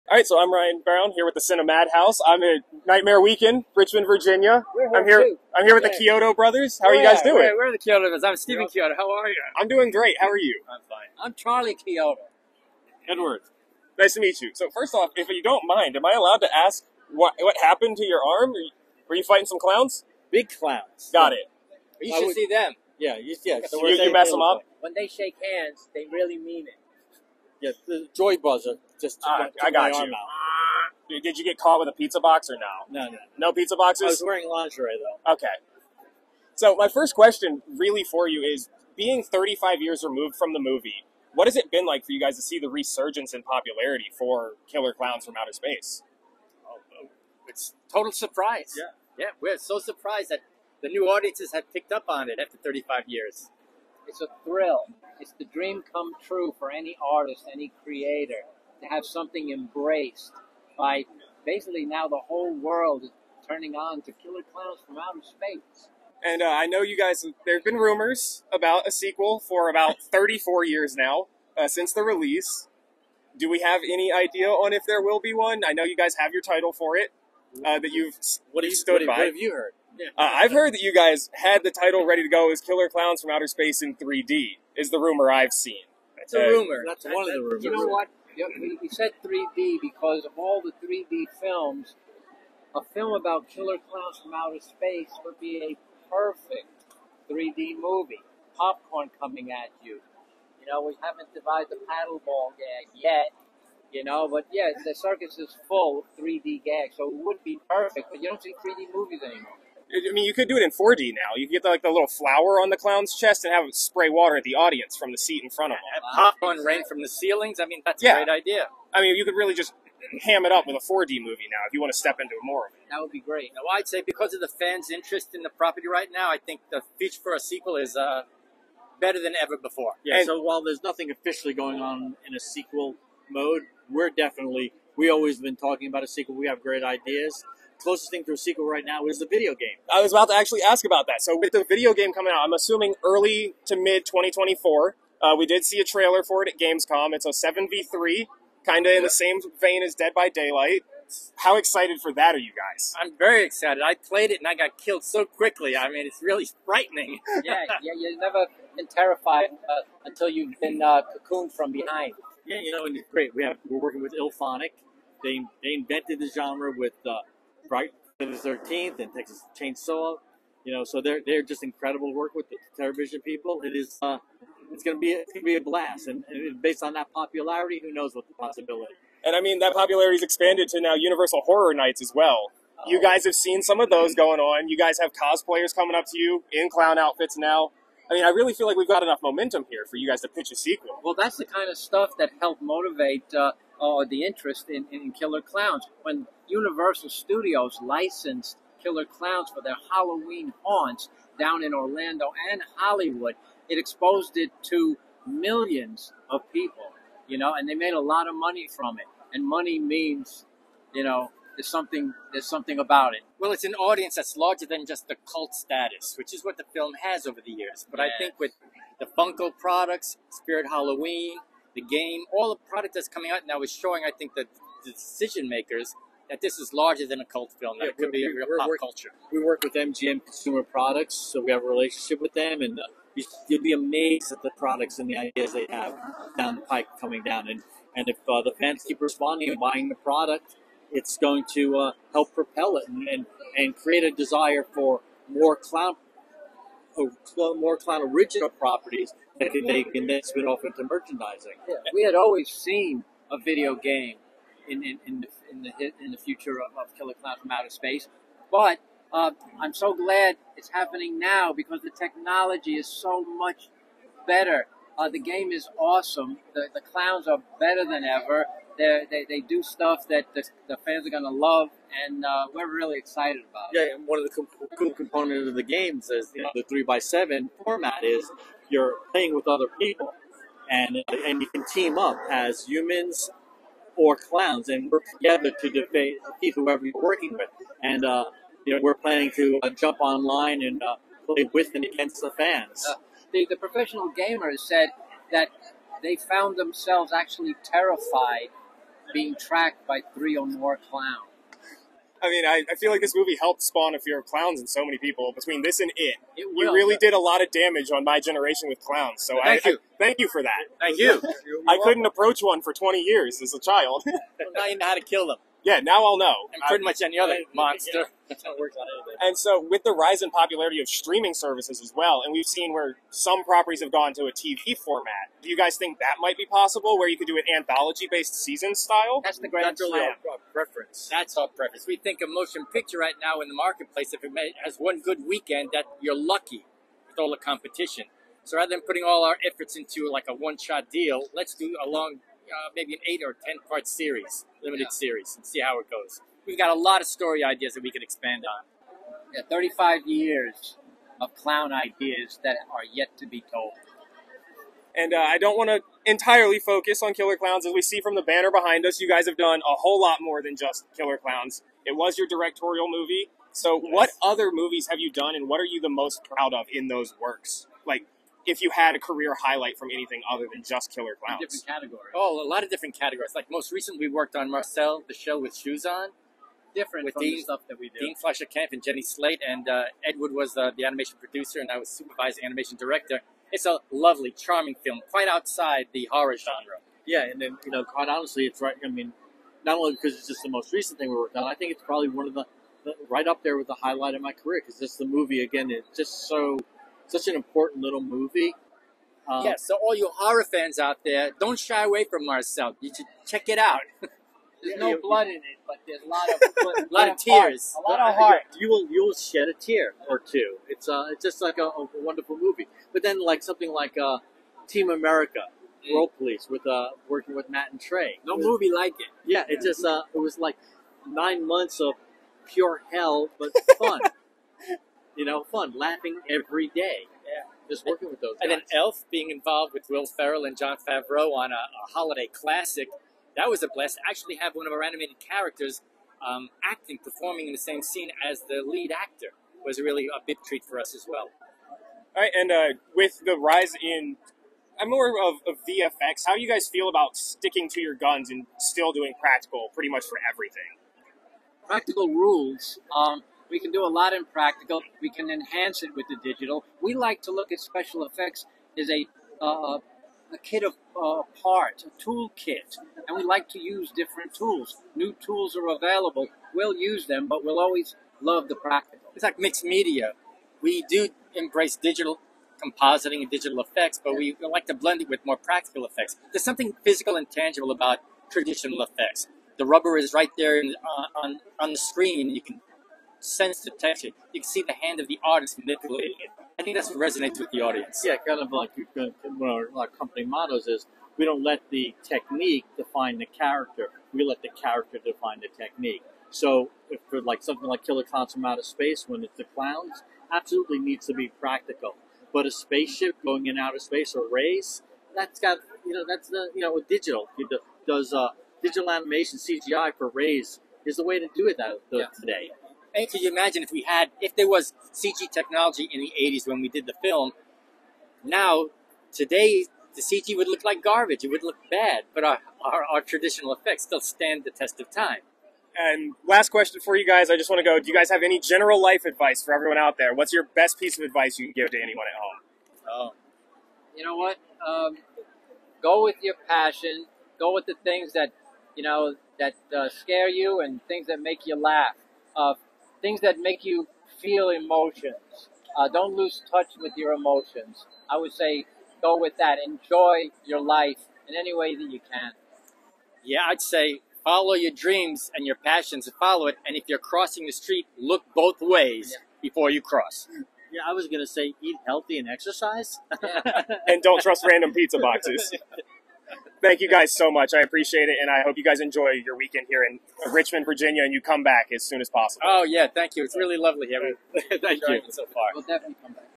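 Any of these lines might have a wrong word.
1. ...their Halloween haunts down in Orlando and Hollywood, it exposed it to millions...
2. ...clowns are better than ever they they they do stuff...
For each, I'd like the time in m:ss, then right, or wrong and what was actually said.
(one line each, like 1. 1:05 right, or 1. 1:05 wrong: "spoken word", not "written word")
1. 3:19 right
2. 4:26 right.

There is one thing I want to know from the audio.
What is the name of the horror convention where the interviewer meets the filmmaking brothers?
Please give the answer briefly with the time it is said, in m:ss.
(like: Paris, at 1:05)
Nightmare Weekend, at 0:02.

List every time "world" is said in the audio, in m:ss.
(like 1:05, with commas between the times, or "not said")
1:02, 6:55.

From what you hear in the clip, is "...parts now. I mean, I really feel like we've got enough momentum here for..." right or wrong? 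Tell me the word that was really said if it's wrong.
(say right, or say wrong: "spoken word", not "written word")
wrong: "outfits", not "parts".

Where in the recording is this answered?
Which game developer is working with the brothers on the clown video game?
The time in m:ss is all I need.
2:44.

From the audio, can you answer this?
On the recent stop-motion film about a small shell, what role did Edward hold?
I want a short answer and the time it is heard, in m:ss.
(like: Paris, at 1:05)
animation producer, at 6:20.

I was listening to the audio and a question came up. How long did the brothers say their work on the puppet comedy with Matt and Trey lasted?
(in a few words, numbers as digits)
9 months.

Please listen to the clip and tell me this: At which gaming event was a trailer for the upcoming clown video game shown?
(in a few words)
Gamescom.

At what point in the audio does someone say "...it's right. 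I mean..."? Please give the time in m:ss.
6:28.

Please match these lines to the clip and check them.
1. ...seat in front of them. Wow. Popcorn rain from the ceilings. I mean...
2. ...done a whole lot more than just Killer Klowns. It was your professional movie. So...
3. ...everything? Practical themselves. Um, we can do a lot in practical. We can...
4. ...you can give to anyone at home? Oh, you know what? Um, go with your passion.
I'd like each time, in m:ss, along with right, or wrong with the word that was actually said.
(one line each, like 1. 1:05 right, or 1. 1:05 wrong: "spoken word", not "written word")
1. 1:55 right
2. 5:59 wrong: "directorial", not "professional"
3. 7:30 wrong: "rules", not "themselves"
4. 8:51 right.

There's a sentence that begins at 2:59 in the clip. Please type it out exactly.
And I mean that popularity's expanded to now Universal Horror Nights as well.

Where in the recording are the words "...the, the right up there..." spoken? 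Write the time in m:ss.
6:32.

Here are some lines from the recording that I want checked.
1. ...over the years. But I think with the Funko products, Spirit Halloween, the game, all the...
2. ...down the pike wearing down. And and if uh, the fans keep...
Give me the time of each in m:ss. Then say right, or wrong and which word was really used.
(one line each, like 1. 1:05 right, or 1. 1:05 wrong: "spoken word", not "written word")
1. 3:37 right
2. 3:56 wrong: "coming", not "wearing".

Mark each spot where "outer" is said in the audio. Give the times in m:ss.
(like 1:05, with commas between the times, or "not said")
0:45, 1:04, 1:23, 1:34, 4:17, 8:18, 8:23.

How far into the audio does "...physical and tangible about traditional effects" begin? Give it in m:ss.
7:56.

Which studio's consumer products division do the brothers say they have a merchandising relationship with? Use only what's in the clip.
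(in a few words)
MGM.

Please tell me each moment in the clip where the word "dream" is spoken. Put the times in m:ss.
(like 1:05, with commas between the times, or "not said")
0:55, 9:14.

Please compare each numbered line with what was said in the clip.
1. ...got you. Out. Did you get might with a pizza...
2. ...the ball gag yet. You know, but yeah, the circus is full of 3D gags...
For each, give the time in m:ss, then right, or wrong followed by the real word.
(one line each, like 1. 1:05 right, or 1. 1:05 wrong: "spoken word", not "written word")
1. 0:29 wrong: "caught", not "might"
2. 1:41 right.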